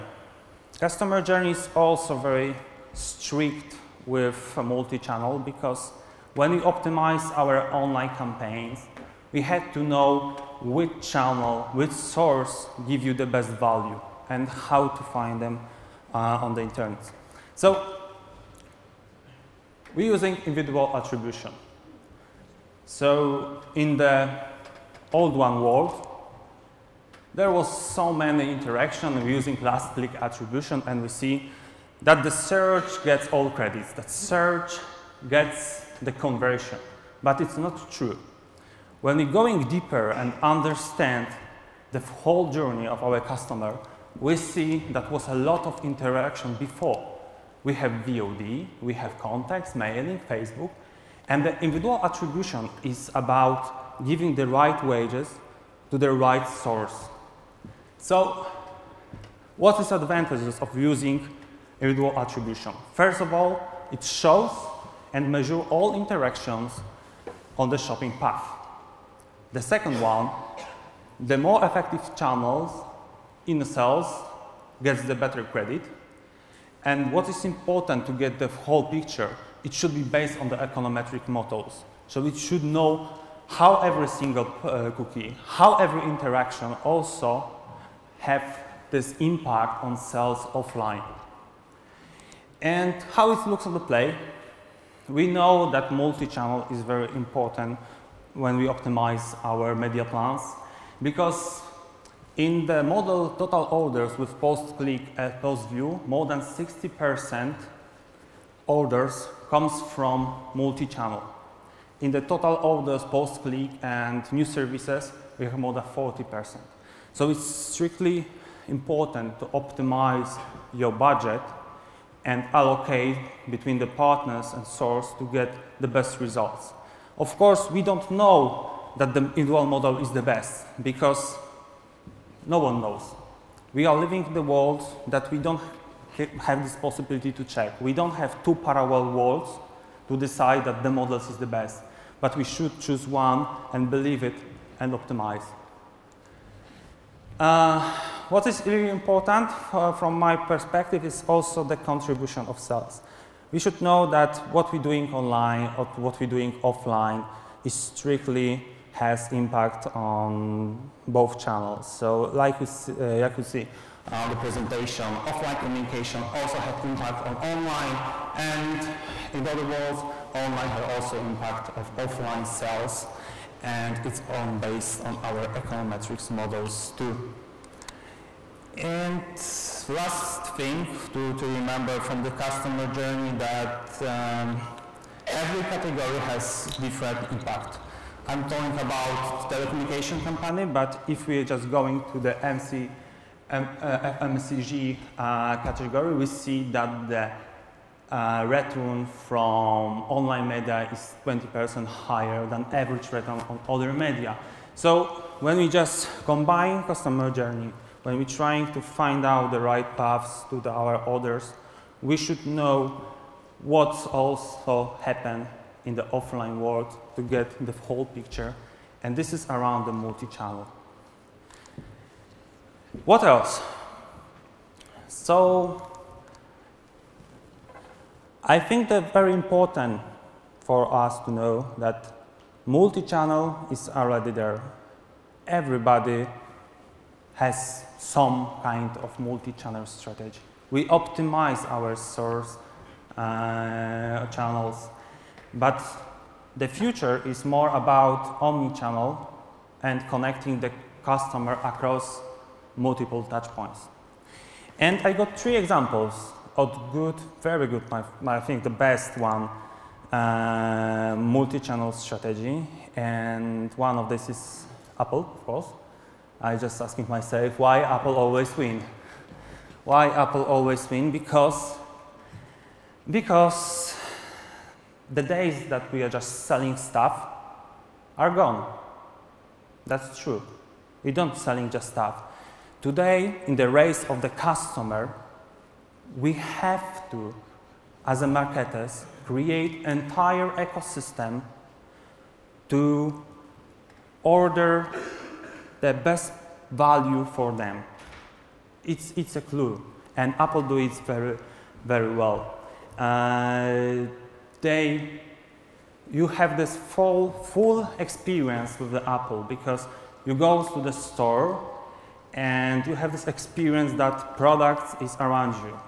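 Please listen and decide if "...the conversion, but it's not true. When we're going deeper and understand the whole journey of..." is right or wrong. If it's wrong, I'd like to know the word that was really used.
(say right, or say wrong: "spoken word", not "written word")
right.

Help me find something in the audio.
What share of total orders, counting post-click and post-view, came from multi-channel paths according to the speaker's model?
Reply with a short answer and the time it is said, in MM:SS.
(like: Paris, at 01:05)
more than 60%, at 01:46.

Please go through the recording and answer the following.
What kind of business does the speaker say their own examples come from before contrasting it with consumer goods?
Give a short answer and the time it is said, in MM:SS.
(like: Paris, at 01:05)
telecommunication company, at 03:09.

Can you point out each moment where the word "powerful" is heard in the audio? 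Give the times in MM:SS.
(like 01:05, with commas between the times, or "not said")
not said.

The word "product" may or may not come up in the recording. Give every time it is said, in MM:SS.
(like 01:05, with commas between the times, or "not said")
05:14.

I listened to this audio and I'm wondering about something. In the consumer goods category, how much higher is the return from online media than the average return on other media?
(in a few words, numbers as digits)
20%.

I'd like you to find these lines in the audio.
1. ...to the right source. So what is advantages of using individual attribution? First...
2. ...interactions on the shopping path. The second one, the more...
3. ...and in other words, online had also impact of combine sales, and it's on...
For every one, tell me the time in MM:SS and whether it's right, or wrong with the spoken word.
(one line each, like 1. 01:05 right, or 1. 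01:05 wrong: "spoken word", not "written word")
1. 00:55 right
2. 01:05 right
3. 02:48 wrong: "offline", not "combine".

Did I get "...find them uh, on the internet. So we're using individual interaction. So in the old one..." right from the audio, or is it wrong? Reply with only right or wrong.
wrong.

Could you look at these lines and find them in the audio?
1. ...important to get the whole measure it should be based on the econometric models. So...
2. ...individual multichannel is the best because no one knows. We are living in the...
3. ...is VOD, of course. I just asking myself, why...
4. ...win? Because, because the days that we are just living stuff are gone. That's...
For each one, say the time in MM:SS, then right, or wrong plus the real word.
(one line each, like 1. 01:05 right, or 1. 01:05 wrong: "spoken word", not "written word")
1. 01:17 wrong: "picture", not "measure"
2. 02:09 wrong: "model", not "multichannel"
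3. 04:24 wrong: "Apple", not "VOD"
4. 04:30 wrong: "selling", not "living".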